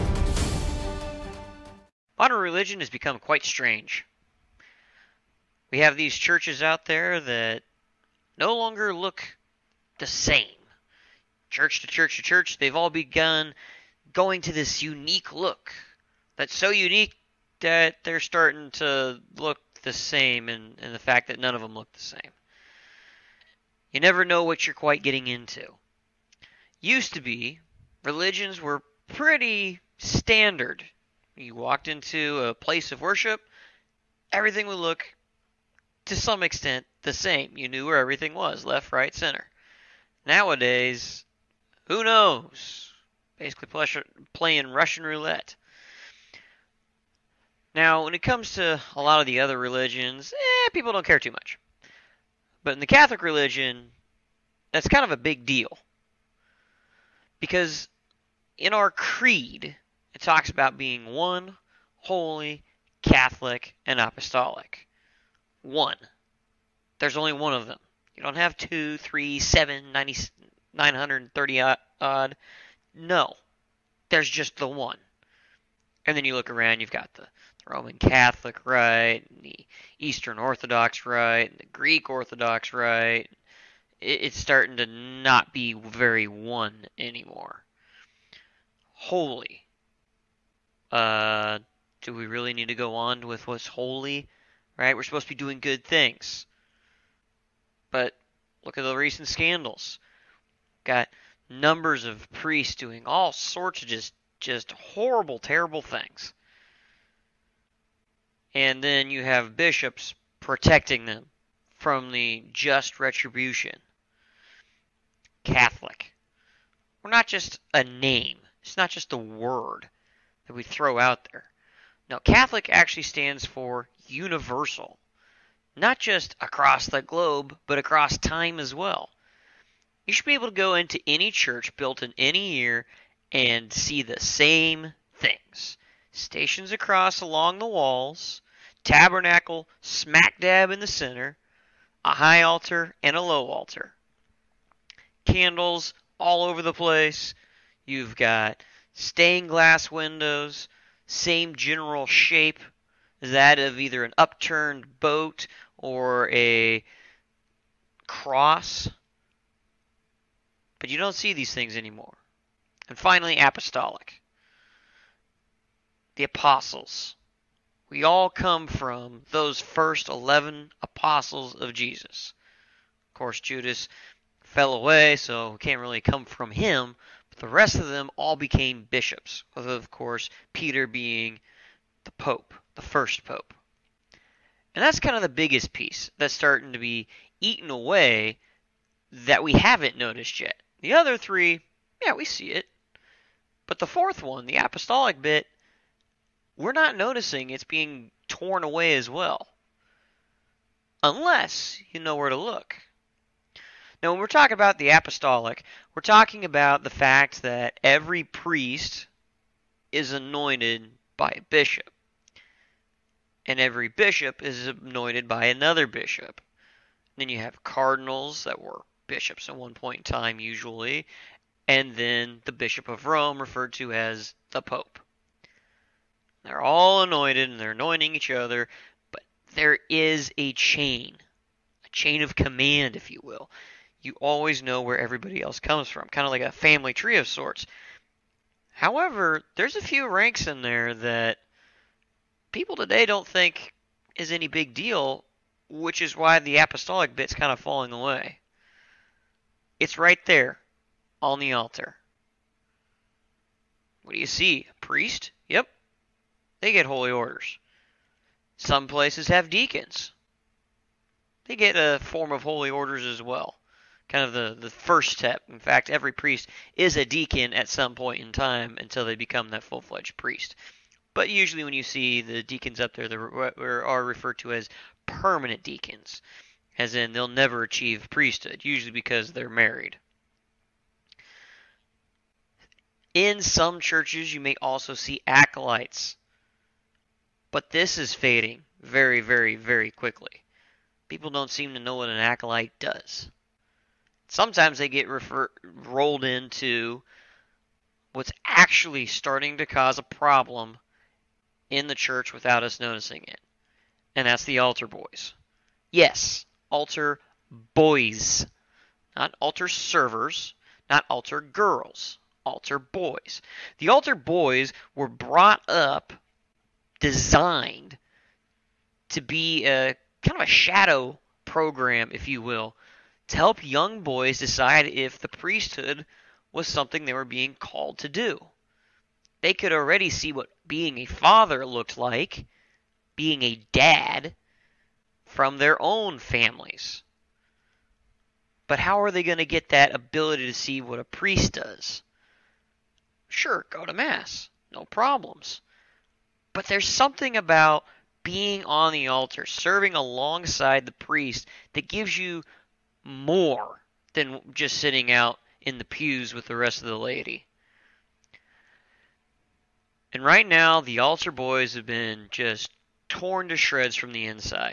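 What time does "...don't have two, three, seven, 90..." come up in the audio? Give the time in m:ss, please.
1:08.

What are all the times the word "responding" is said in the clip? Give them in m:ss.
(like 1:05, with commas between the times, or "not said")
not said.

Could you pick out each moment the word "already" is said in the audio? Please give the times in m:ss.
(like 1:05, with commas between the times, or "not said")
5:29.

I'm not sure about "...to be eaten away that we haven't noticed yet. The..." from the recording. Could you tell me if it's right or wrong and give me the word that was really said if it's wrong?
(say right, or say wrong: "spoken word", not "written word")
right.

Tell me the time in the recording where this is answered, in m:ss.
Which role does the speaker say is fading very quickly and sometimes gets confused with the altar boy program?
4:45.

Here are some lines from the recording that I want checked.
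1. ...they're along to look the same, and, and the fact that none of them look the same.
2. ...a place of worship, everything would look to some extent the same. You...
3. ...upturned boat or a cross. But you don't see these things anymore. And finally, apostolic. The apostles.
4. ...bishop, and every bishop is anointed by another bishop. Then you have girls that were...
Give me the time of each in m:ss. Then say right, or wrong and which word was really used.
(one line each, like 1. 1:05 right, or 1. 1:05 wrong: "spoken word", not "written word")
1. 0:18 wrong: "starting", not "along"
2. 0:32 right
3. 2:34 right
4. 3:31 wrong: "cardinals", not "girls".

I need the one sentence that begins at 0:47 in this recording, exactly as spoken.
Now, when it comes to a lot of the other religions, eh, people don't care too much.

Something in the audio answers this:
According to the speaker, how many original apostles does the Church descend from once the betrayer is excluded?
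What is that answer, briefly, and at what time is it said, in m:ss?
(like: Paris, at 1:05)
11, at 2:50.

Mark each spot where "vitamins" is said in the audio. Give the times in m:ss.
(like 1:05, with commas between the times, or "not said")
not said.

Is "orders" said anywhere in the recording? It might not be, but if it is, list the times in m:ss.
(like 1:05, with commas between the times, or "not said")
4:17, 4:22.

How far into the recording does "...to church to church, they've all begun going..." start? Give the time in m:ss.
0:11.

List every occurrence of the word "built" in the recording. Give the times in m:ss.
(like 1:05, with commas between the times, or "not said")
2:11.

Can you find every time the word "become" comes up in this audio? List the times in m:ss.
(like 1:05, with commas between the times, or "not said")
0:02, 4:29.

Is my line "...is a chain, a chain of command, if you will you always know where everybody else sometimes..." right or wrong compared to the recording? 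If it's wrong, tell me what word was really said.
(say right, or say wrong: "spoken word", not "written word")
wrong: "comes", not "sometimes".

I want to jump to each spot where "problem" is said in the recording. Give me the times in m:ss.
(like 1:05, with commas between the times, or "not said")
5:00, 5:44.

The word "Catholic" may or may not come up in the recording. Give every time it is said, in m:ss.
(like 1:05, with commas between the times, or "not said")
0:52, 1:03, 1:17, 1:55, 2:02.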